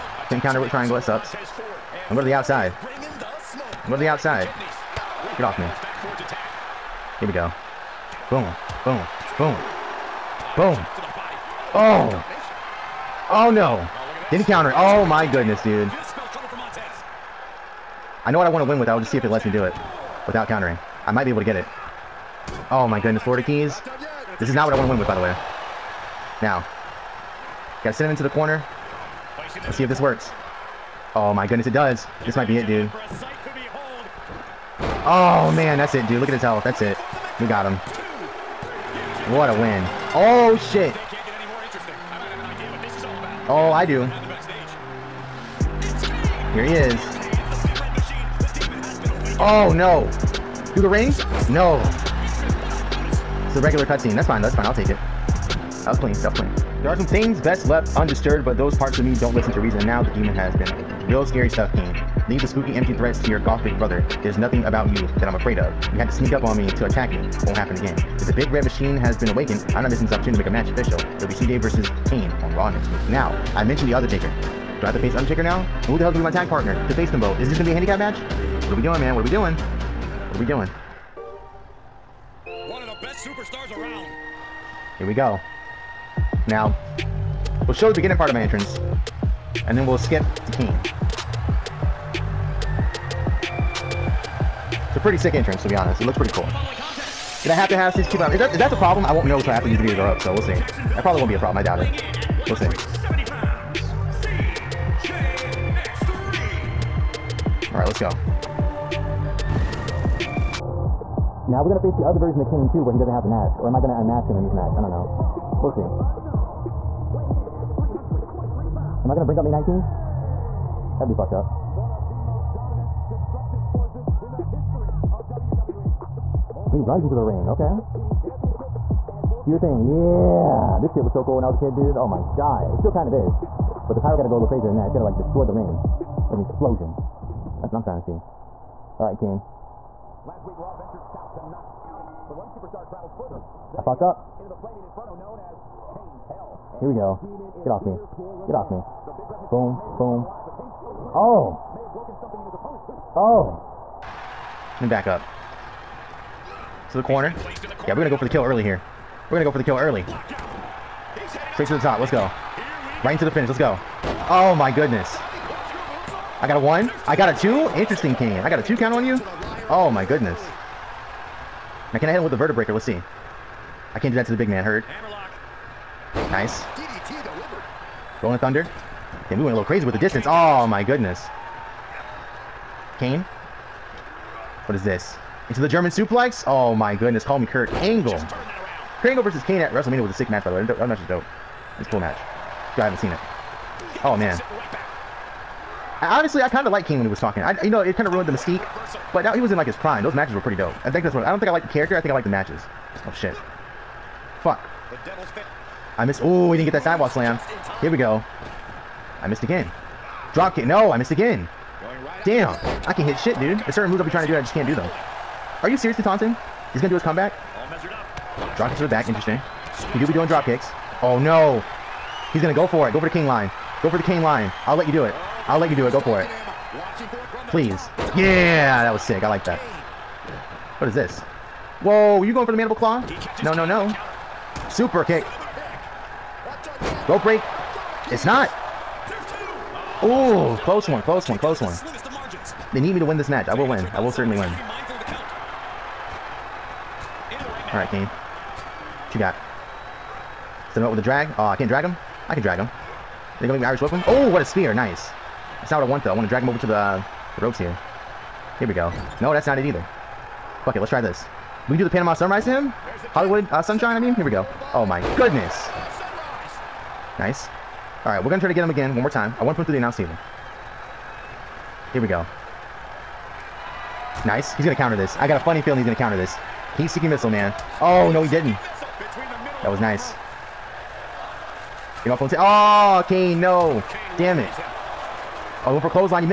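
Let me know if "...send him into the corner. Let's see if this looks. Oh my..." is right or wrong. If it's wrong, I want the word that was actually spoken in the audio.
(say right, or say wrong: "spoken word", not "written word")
wrong: "works", not "looks".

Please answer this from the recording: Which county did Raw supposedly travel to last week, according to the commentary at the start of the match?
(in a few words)
Knox County.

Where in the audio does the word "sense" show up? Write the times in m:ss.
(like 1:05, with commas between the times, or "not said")
not said.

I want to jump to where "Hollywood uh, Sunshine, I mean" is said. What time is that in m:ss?
4:23.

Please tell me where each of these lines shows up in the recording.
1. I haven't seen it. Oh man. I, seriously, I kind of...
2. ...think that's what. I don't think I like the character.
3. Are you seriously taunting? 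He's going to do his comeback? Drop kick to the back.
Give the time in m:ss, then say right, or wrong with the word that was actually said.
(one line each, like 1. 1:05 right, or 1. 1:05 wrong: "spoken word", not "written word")
1. 3:12 wrong: "honestly", not "seriously"
2. 3:20 right
3. 3:35 right.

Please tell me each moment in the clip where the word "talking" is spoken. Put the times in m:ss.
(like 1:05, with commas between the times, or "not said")
3:17.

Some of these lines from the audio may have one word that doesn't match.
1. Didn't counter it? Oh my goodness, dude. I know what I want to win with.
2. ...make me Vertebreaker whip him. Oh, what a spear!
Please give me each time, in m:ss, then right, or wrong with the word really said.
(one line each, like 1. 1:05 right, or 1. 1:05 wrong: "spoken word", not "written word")
1. 0:14 right
2. 4:13 wrong: "Irish", not "Vertebreaker".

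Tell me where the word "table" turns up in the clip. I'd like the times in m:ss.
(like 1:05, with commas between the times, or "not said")
4:29.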